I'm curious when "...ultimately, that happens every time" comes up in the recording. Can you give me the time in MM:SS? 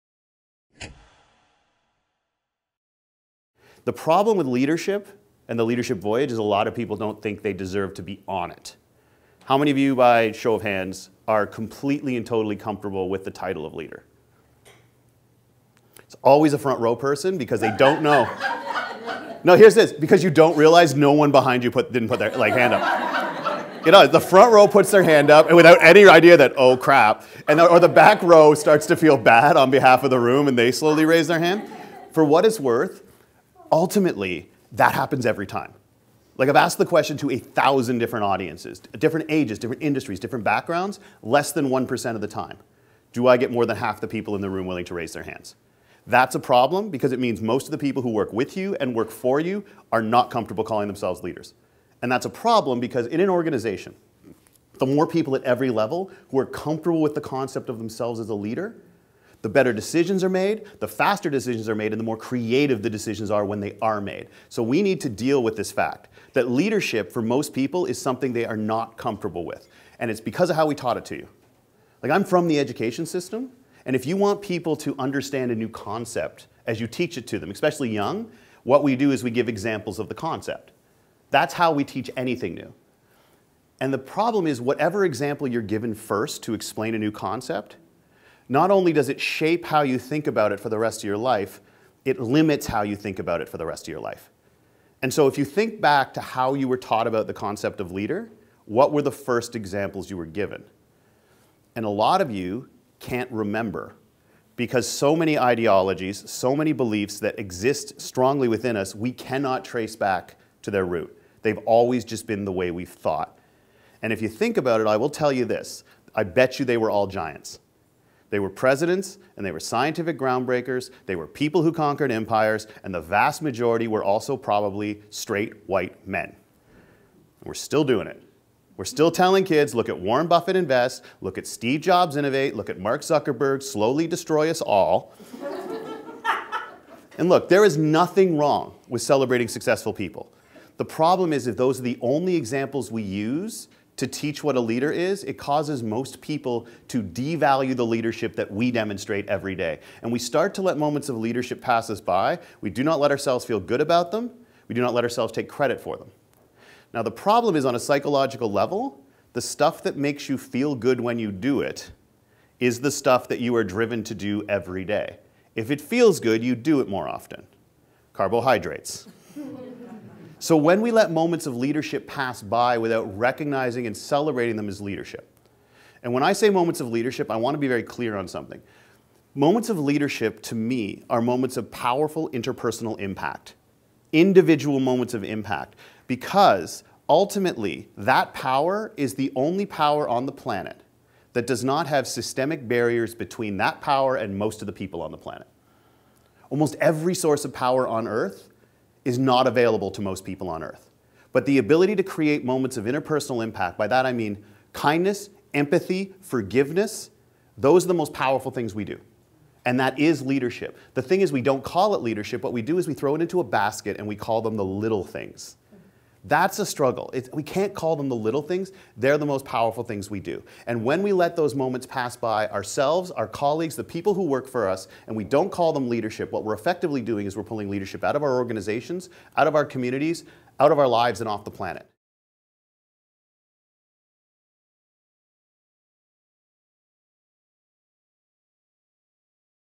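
00:33.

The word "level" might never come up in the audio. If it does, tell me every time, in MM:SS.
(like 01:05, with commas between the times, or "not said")
00:55, 02:38.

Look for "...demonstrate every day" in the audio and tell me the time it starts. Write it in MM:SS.
02:28.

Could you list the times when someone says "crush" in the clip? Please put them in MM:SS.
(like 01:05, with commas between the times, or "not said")
not said.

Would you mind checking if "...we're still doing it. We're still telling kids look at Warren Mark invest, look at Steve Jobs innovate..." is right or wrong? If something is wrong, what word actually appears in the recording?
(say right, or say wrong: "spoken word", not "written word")
wrong: "Buffett", not "Mark".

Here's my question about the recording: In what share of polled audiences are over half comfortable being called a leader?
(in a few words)
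less than 1%.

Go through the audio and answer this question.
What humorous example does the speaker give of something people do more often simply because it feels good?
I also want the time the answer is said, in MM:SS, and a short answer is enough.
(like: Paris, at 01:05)
Carbohydrates, at 02:48.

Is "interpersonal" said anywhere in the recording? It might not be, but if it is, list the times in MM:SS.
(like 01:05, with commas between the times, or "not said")
03:02, 03:22.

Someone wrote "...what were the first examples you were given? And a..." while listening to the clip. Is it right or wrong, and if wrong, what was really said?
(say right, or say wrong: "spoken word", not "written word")
right.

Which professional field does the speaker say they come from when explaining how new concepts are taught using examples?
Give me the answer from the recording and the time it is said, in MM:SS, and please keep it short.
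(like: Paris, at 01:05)
education system, at 01:12.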